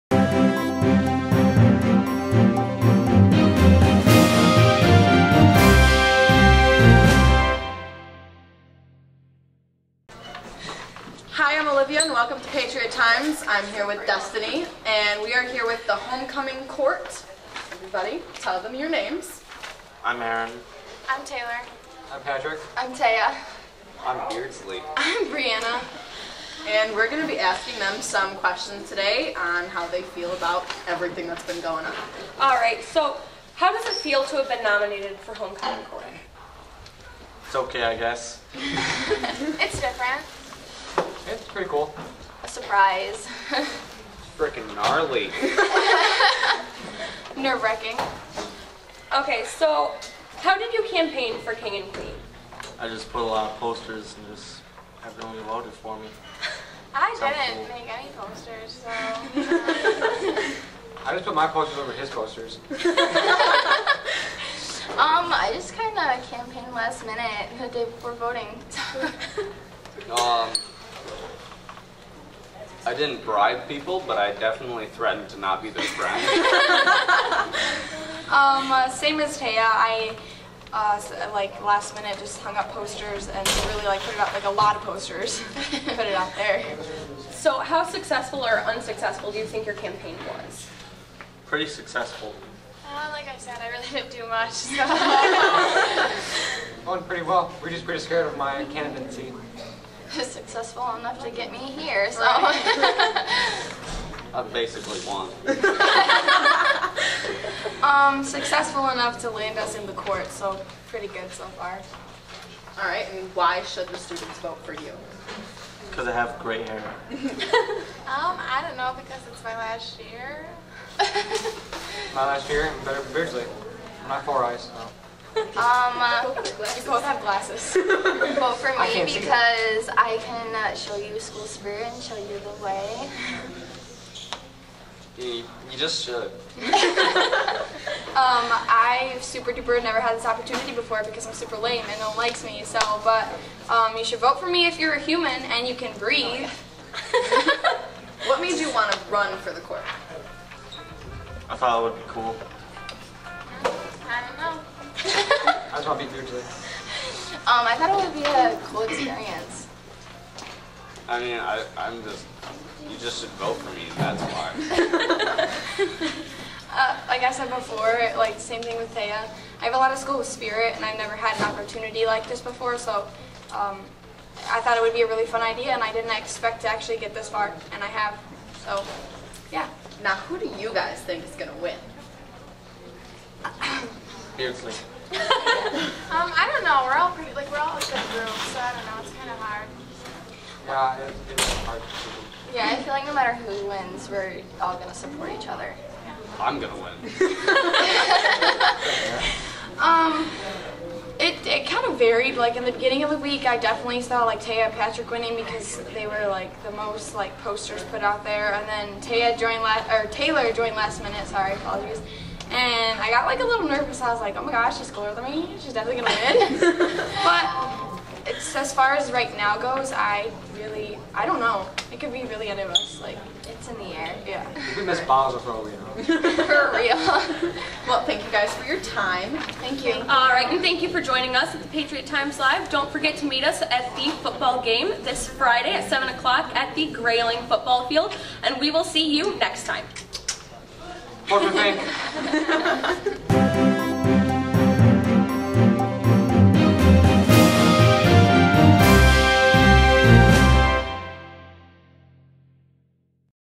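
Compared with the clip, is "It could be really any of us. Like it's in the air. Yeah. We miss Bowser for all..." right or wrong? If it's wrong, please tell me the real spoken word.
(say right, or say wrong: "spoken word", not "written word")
right.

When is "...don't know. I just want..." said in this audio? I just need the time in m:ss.
2:34.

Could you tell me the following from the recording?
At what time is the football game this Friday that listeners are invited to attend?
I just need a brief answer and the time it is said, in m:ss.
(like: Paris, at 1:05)
7 o'clock, at 3:55.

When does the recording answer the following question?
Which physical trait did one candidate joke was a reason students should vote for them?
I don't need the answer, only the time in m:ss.
1:56.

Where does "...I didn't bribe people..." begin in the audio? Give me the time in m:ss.
1:12.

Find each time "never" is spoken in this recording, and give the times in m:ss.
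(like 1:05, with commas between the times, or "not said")
2:19, 2:50.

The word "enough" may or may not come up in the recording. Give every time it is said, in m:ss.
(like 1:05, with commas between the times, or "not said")
1:40, 1:48.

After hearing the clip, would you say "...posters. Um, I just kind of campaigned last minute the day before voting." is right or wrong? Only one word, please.
right.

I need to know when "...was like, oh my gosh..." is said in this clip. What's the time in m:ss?
3:34.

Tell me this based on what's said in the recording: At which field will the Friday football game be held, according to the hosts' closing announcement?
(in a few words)
Grayling football field.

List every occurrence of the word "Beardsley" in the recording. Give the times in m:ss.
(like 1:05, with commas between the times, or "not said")
0:24, 2:03, 3:04.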